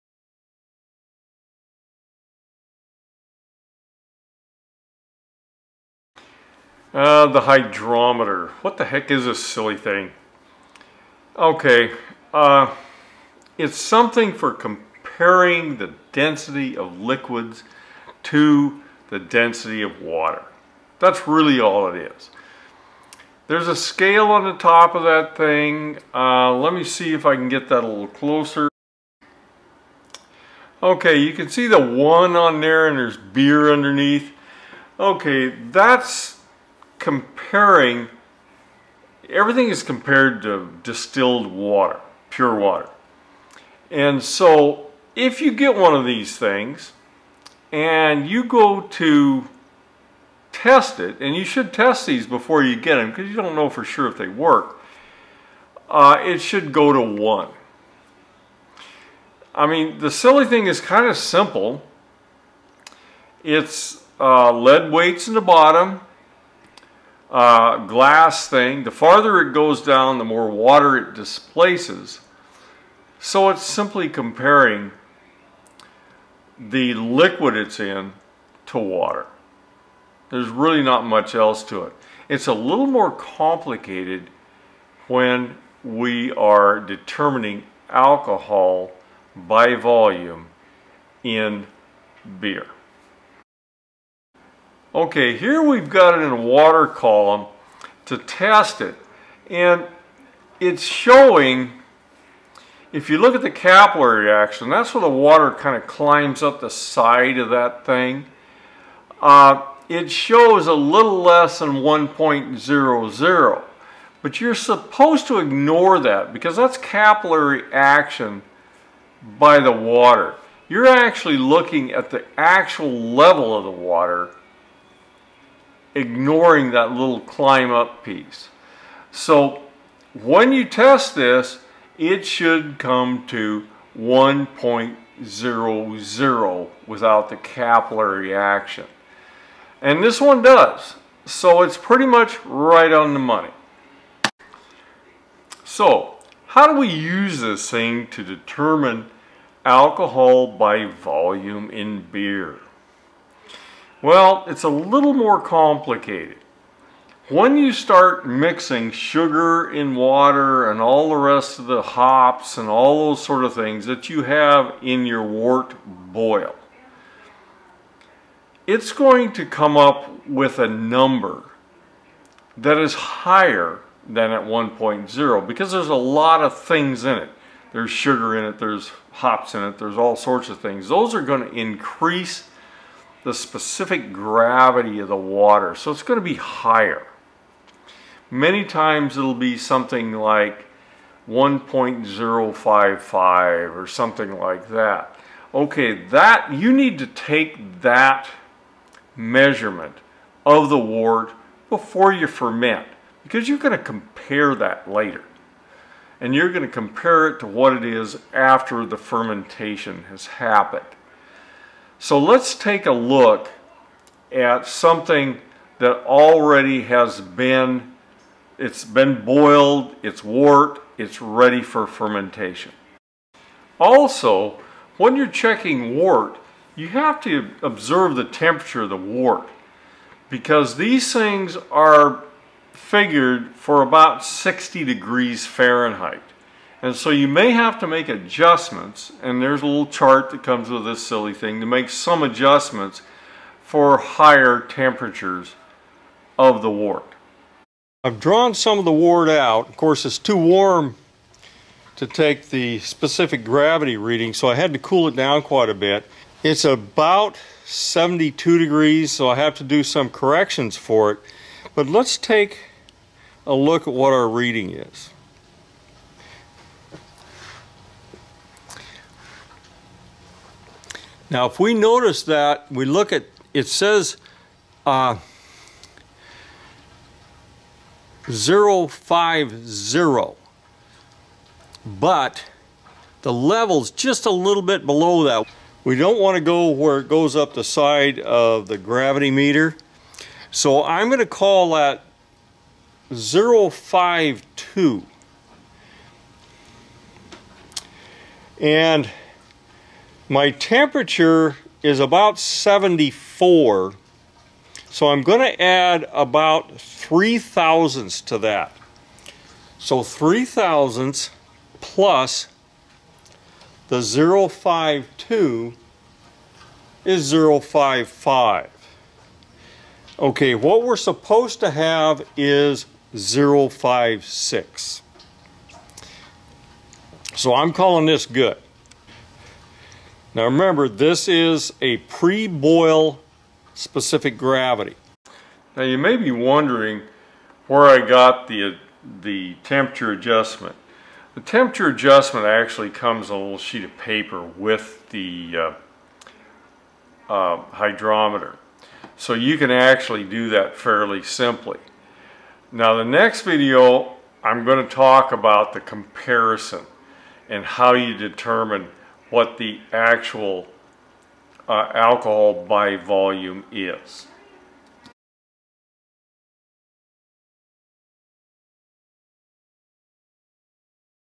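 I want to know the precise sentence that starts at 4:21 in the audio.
But let's take a look at what our reading is.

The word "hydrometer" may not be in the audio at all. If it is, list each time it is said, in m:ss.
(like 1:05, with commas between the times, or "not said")
0:07, 5:47.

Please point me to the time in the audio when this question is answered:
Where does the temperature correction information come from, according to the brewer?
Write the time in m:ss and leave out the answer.
5:43.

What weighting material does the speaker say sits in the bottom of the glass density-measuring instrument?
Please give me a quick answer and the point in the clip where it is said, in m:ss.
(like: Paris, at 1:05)
lead weights, at 1:04.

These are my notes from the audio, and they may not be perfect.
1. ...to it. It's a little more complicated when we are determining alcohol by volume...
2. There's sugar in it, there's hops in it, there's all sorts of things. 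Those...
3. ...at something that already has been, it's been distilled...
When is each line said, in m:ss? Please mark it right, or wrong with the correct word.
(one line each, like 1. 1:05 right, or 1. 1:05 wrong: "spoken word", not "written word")
1. 1:21 right
2. 2:57 right
3. 3:34 wrong: "boiled", not "distilled".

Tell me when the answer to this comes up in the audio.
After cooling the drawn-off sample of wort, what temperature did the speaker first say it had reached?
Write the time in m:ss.
4:17.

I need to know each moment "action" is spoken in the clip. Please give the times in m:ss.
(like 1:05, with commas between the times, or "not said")
1:44, 1:57, 2:18.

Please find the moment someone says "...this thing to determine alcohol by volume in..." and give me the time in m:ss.
2:27.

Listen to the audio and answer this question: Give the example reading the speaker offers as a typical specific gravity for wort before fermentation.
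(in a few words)
1.055.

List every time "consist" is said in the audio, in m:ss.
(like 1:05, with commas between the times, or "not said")
not said.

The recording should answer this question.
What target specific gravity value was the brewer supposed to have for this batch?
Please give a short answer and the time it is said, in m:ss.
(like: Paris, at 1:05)
056, at 5:23.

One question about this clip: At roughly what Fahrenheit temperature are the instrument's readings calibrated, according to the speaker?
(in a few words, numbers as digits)
60 degrees.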